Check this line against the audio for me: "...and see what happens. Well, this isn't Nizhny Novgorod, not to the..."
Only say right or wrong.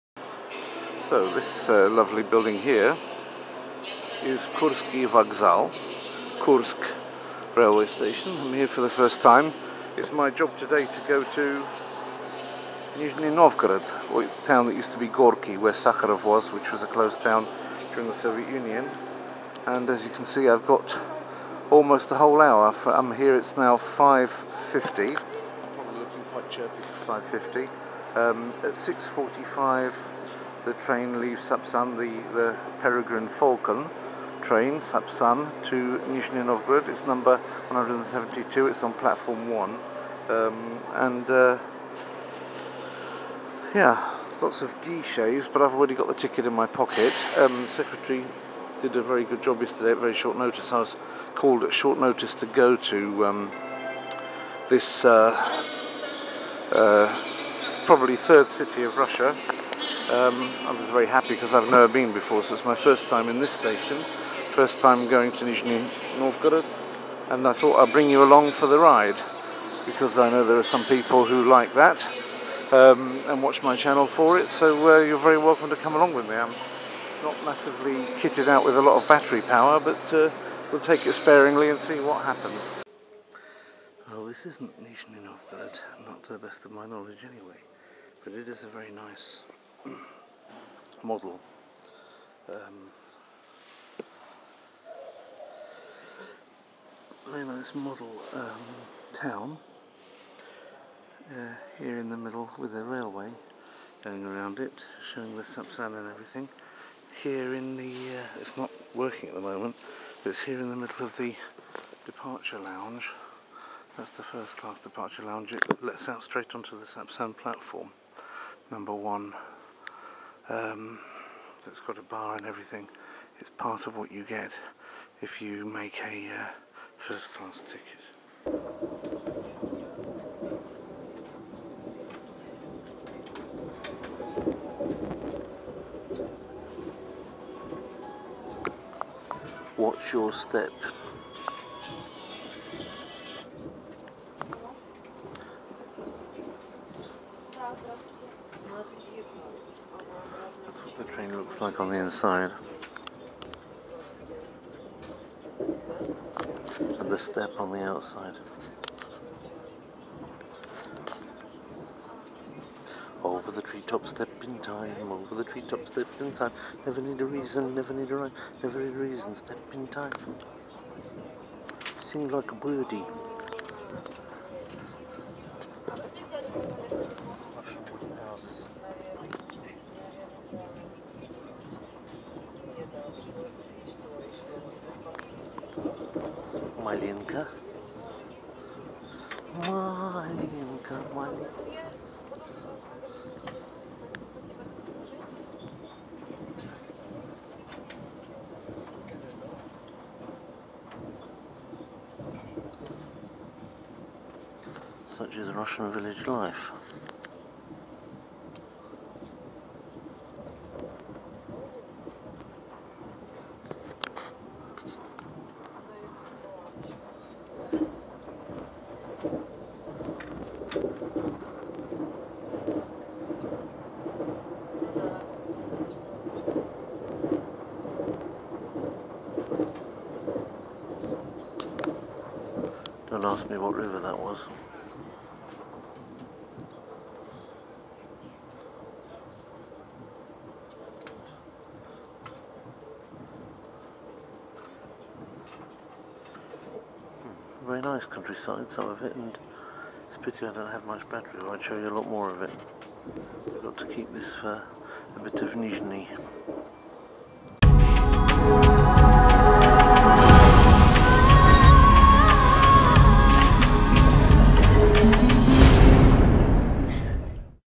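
right.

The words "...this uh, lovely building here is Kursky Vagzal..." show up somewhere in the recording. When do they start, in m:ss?
0:01.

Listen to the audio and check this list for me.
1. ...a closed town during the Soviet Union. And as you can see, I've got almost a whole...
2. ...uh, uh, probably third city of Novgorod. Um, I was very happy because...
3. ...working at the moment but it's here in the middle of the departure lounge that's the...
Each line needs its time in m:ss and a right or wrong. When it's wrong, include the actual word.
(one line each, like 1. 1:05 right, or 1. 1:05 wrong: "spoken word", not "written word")
1. 0:16 right
2. 0:55 wrong: "Russia", not "Novgorod"
3. 1:48 right.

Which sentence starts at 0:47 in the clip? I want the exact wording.
Um, secretary did a very good job yesterday at very short notice.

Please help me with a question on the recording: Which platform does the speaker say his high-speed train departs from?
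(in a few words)
Platform 1.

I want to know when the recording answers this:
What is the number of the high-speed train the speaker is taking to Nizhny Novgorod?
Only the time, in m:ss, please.
0:37.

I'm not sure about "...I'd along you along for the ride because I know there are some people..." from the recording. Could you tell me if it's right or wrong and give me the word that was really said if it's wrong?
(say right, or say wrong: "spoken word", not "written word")
wrong: "bring", not "along".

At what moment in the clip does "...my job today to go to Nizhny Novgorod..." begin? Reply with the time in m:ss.
0:10.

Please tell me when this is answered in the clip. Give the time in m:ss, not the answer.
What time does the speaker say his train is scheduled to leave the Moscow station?
0:28.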